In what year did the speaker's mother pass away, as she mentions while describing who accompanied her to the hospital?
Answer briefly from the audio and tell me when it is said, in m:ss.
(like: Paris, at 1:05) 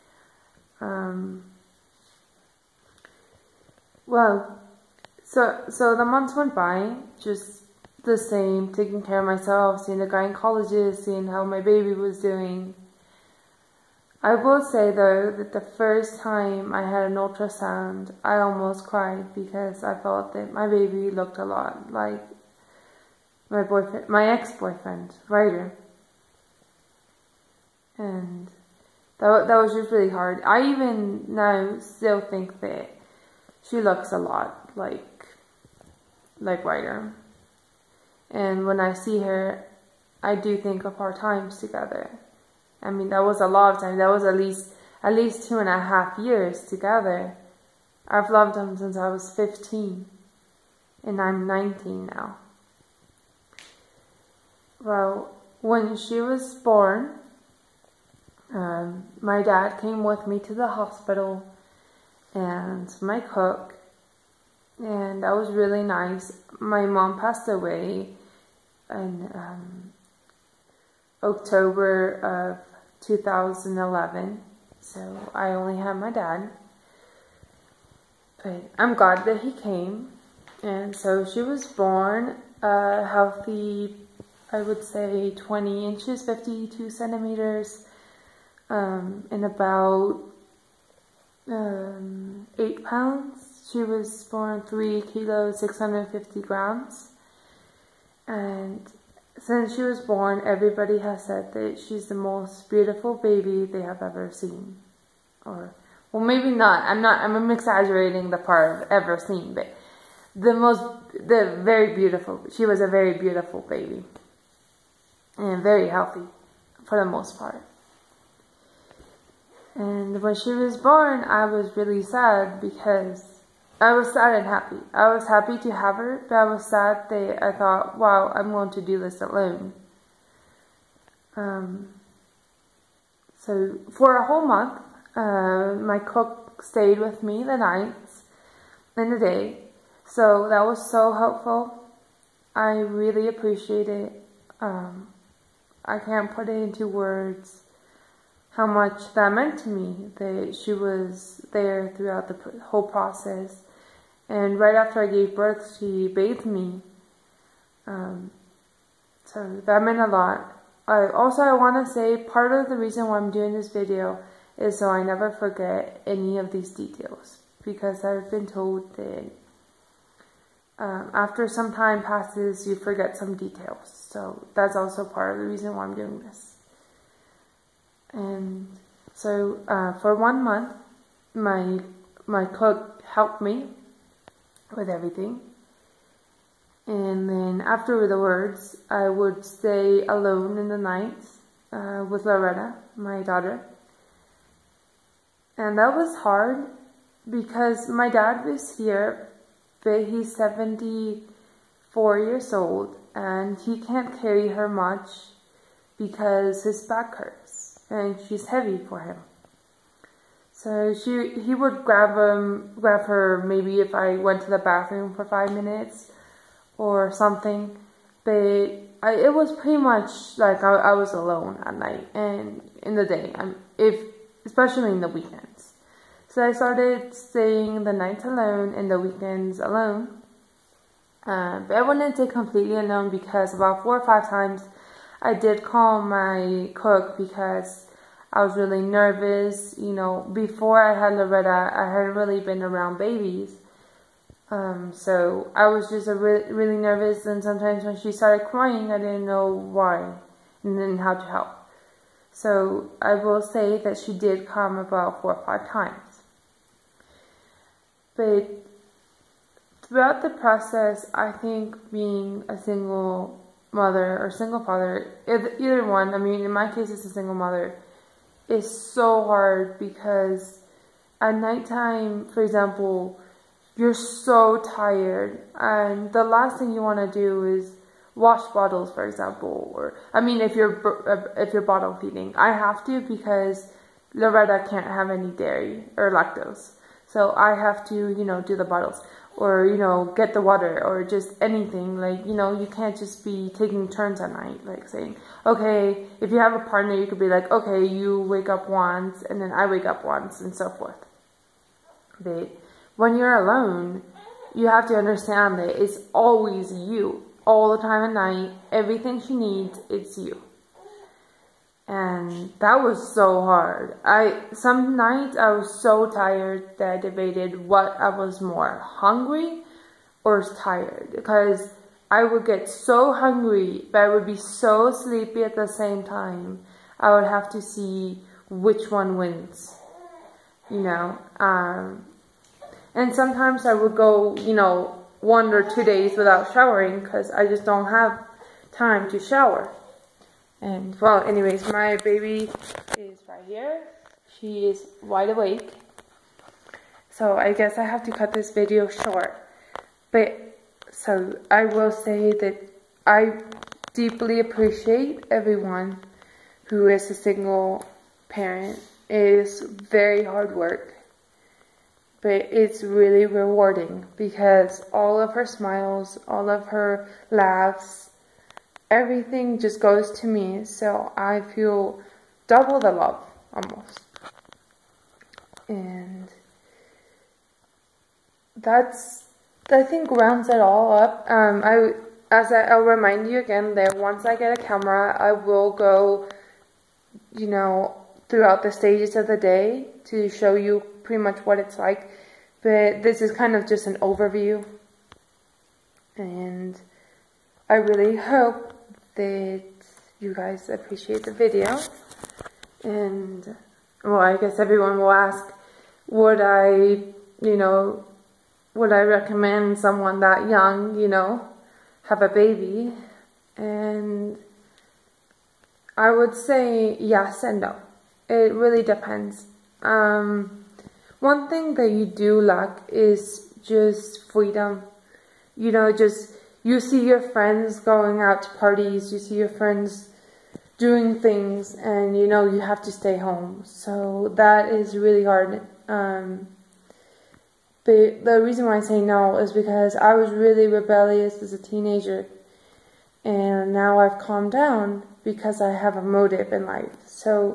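2011, at 1:13.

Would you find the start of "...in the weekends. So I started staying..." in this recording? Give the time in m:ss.
3:44.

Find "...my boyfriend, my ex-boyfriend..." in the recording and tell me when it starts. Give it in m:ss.
0:23.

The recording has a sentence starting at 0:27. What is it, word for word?
And that that was just really hard.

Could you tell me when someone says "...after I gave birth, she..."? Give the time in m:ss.
2:34.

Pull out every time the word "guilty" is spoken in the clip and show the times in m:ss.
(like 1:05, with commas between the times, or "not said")
not said.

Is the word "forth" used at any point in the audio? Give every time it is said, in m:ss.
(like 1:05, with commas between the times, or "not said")
5:00.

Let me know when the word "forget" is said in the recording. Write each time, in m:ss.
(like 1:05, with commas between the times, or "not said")
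2:45, 2:52.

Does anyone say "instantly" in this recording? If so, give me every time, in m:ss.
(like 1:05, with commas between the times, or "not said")
not said.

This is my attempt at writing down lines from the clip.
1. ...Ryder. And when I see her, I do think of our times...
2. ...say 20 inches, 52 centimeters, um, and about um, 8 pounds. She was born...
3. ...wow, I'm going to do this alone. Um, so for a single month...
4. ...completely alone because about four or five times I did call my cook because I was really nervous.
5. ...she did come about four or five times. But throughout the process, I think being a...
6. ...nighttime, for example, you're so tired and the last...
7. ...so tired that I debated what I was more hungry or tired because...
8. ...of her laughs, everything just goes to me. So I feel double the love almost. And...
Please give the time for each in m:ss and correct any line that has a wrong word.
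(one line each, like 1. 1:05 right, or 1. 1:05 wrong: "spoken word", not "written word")
1. 0:36 right
2. 1:24 right
3. 2:07 wrong: "whole", not "single"
4. 3:52 right
5. 4:13 right
6. 4:31 right
7. 5:15 right
8. 6:06 right.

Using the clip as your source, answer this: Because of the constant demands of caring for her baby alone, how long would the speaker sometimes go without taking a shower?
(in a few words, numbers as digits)
1 or 2 days.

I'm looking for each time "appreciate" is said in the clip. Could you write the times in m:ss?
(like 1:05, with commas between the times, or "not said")
2:23, 5:54, 6:40.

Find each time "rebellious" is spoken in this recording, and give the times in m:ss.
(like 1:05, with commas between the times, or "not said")
7:20.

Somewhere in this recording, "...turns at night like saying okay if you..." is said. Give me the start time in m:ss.
4:53.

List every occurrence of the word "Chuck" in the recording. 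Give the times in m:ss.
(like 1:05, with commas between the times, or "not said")
not said.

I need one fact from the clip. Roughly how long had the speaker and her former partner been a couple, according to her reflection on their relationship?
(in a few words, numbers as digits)
2 and a half years.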